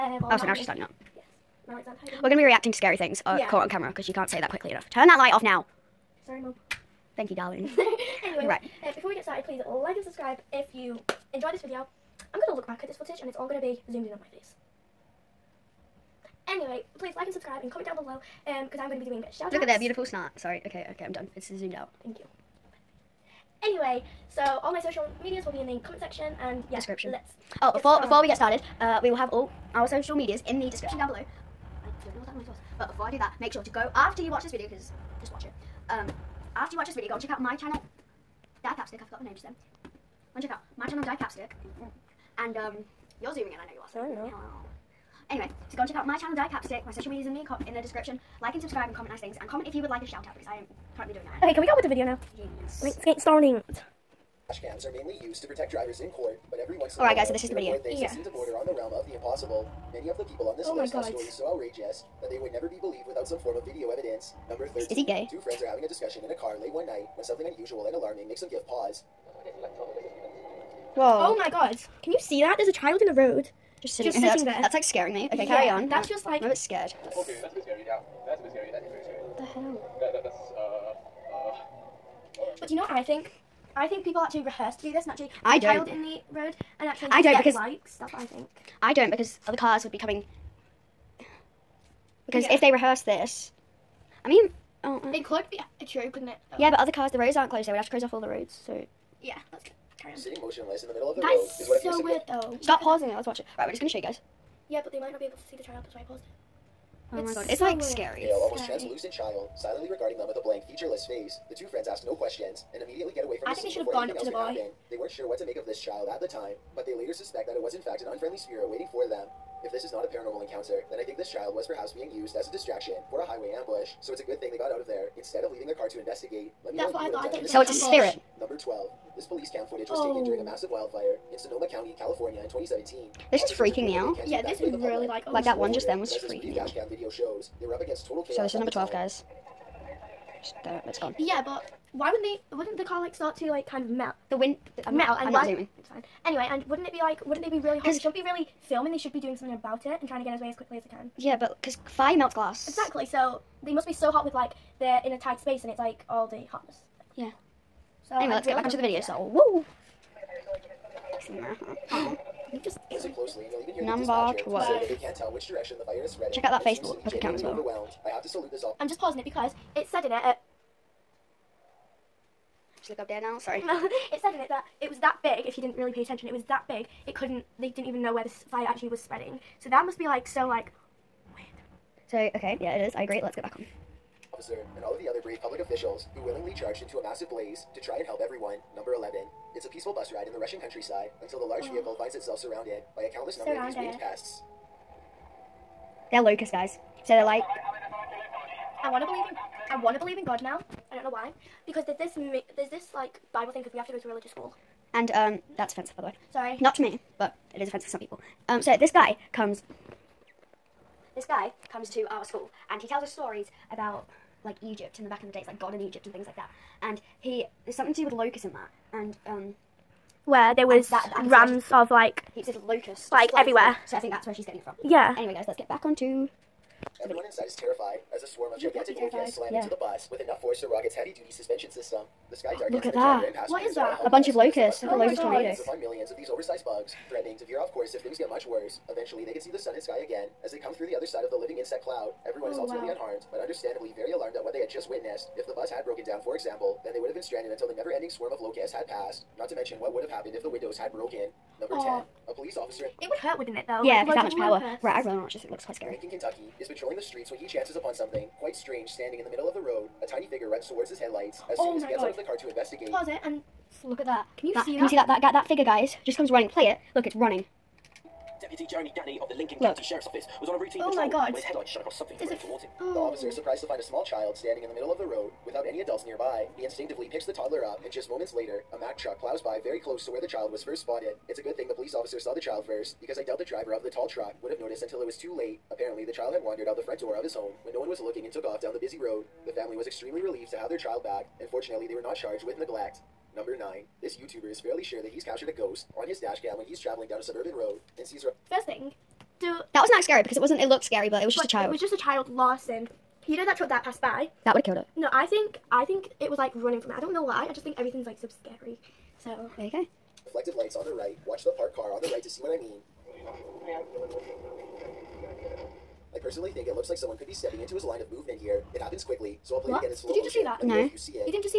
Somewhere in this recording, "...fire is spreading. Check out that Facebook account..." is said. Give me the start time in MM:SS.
02:45.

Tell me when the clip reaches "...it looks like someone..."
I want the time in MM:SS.
05:16.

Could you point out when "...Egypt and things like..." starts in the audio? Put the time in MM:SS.
03:35.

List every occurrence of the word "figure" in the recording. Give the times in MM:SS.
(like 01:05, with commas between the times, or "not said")
04:20, 04:25.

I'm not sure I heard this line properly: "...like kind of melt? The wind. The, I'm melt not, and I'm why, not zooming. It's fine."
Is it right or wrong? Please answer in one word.
right.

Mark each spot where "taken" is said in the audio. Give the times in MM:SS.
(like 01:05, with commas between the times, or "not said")
02:10.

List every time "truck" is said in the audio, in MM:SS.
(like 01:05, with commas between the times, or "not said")
04:38, 04:44, 05:03.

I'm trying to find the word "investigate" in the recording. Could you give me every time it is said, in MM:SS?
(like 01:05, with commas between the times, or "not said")
02:05, 04:22.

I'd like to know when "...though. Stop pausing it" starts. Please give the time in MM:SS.
01:42.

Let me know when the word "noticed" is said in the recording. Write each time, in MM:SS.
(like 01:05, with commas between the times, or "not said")
04:44.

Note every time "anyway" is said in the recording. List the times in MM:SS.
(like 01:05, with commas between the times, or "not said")
00:08, 00:16, 00:23, 00:45, 02:26, 02:38, 03:45.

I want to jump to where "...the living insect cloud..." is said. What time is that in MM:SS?
04:01.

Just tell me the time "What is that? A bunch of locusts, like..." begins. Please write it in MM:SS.
03:53.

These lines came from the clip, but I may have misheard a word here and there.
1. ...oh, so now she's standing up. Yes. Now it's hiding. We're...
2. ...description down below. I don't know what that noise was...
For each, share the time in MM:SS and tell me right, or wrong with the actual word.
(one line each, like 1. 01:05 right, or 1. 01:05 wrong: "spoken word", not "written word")
1. 00:00 right
2. 00:30 right.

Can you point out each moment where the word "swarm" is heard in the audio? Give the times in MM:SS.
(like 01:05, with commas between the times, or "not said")
03:48, 04:08.